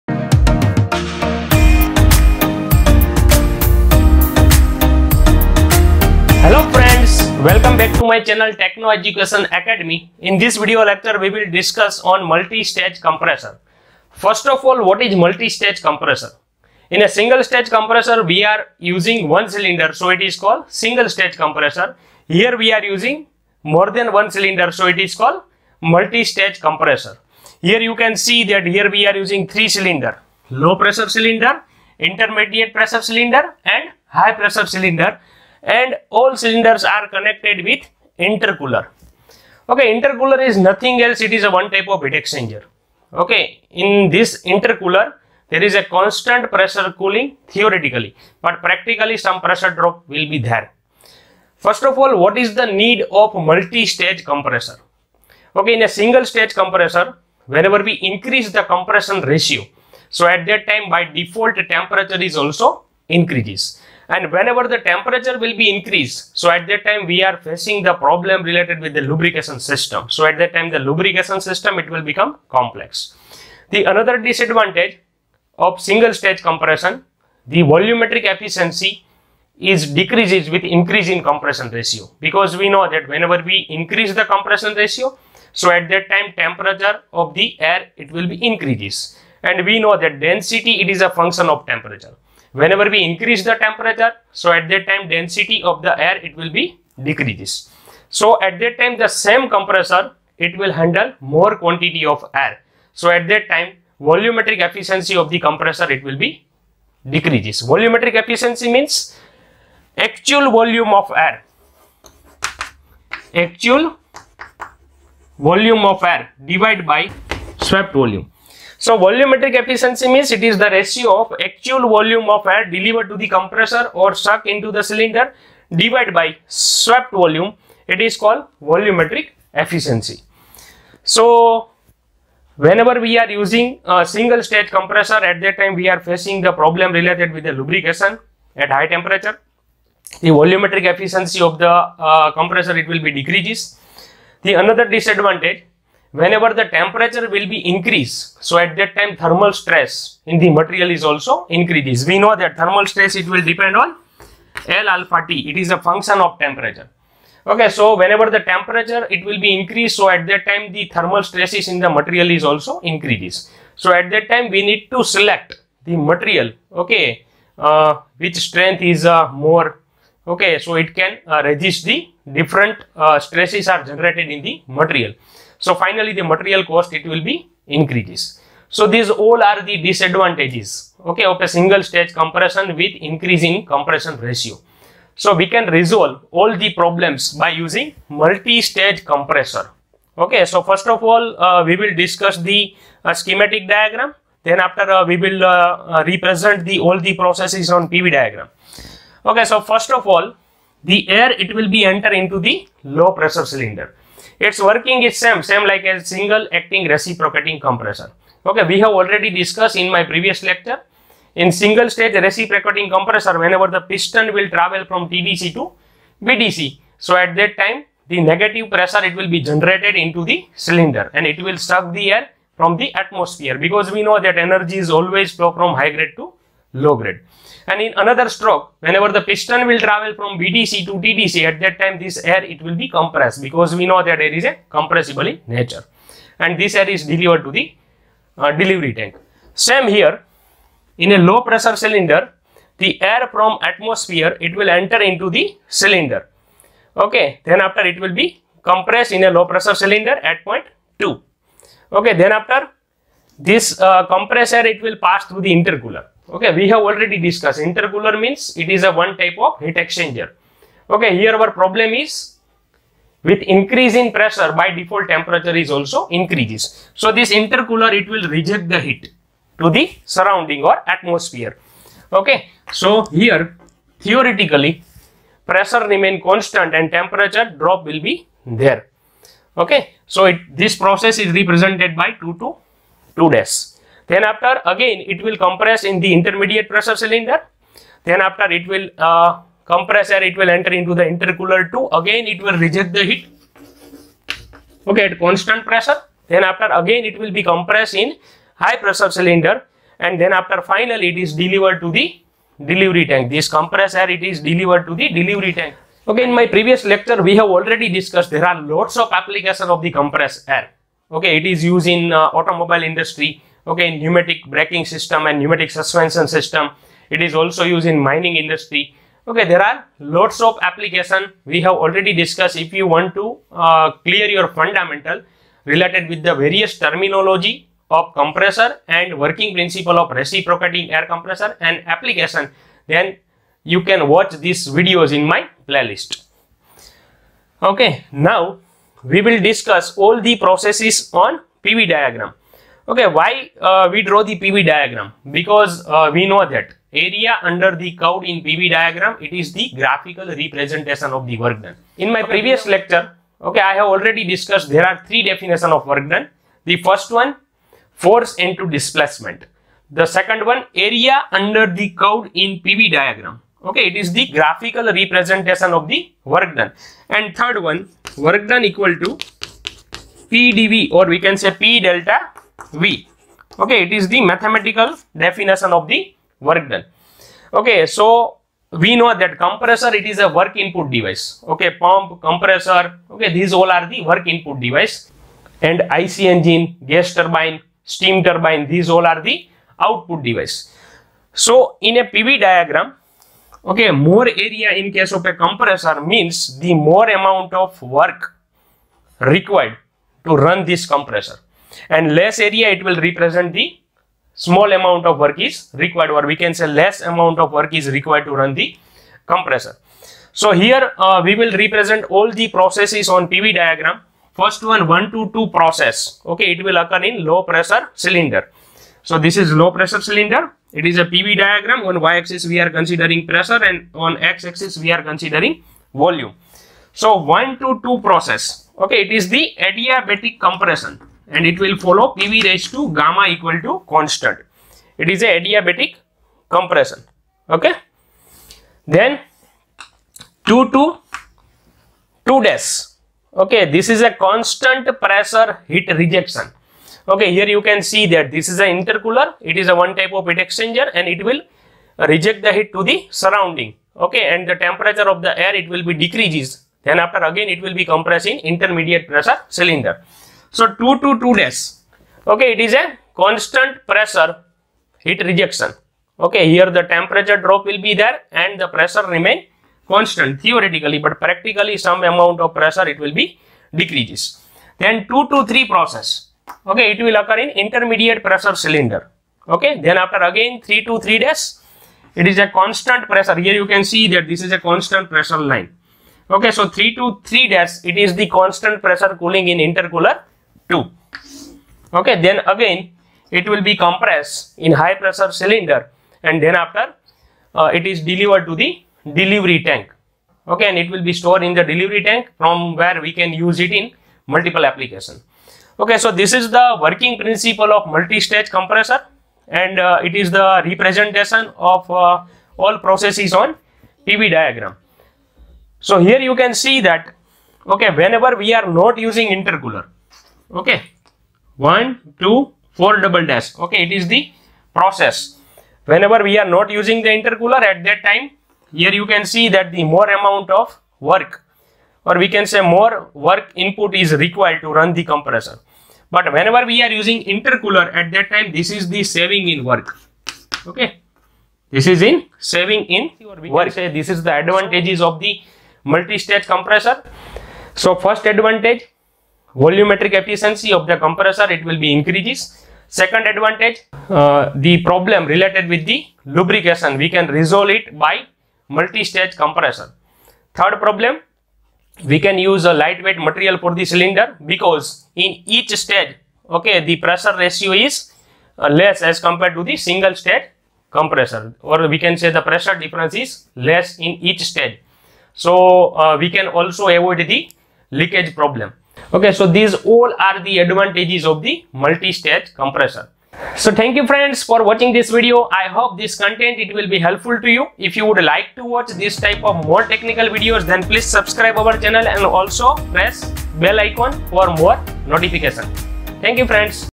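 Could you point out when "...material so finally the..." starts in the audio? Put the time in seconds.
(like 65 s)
174 s.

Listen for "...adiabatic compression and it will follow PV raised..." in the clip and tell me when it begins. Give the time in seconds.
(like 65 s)
429 s.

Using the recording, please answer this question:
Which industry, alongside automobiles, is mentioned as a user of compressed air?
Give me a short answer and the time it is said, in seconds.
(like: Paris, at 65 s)
mining industry, at 317 s.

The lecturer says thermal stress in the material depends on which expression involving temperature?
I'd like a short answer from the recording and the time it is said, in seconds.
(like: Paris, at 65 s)
L alpha T, at 154 s.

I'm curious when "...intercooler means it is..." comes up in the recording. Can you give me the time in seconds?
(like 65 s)
257 s.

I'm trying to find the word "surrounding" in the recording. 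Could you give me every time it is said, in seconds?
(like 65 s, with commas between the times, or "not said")
270 s, 453 s.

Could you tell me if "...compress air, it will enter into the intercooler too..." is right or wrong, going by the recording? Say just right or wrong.
right.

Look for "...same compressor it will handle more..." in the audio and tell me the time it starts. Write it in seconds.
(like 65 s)
99 s.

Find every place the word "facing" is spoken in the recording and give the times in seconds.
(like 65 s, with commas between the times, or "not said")
67 s, 135 s.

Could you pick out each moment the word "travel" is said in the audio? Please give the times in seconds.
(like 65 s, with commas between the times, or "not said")
214 s, 229 s.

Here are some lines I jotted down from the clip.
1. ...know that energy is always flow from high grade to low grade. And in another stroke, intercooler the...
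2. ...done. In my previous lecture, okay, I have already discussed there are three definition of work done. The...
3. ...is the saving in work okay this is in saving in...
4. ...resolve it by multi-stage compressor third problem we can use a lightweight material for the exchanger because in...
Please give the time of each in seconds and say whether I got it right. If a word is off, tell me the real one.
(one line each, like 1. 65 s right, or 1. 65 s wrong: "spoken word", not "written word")
1. 224 s wrong: "whenever", not "intercooler"
2. 351 s right
3. 538 s right
4. 557 s wrong: "cylinder", not "exchanger".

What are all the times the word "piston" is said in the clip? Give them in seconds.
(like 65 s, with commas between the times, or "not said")
213 s, 229 s.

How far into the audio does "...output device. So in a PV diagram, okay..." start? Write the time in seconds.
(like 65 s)
389 s.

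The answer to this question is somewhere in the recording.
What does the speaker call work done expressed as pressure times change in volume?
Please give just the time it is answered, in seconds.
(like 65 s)
374 s.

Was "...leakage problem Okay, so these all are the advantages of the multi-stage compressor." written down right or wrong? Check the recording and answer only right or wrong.
right.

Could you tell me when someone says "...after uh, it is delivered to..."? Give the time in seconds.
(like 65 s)
496 s.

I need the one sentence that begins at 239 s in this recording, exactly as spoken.
Same here, in a low pressure cylinder, the air from atmosphere, it will enter into the cylinder.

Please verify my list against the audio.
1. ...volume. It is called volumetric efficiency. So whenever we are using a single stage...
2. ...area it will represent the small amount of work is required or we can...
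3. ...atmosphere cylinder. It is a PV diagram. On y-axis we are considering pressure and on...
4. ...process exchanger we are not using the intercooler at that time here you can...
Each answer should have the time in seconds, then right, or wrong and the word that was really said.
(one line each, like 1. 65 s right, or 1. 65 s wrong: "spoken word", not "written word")
1. 127 s right
2. 402 s right
3. 419 s wrong: "pressure", not "atmosphere"
4. 524 s wrong: "whenever", not "exchanger".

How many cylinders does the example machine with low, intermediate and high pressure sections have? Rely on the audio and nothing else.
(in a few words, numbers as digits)
3.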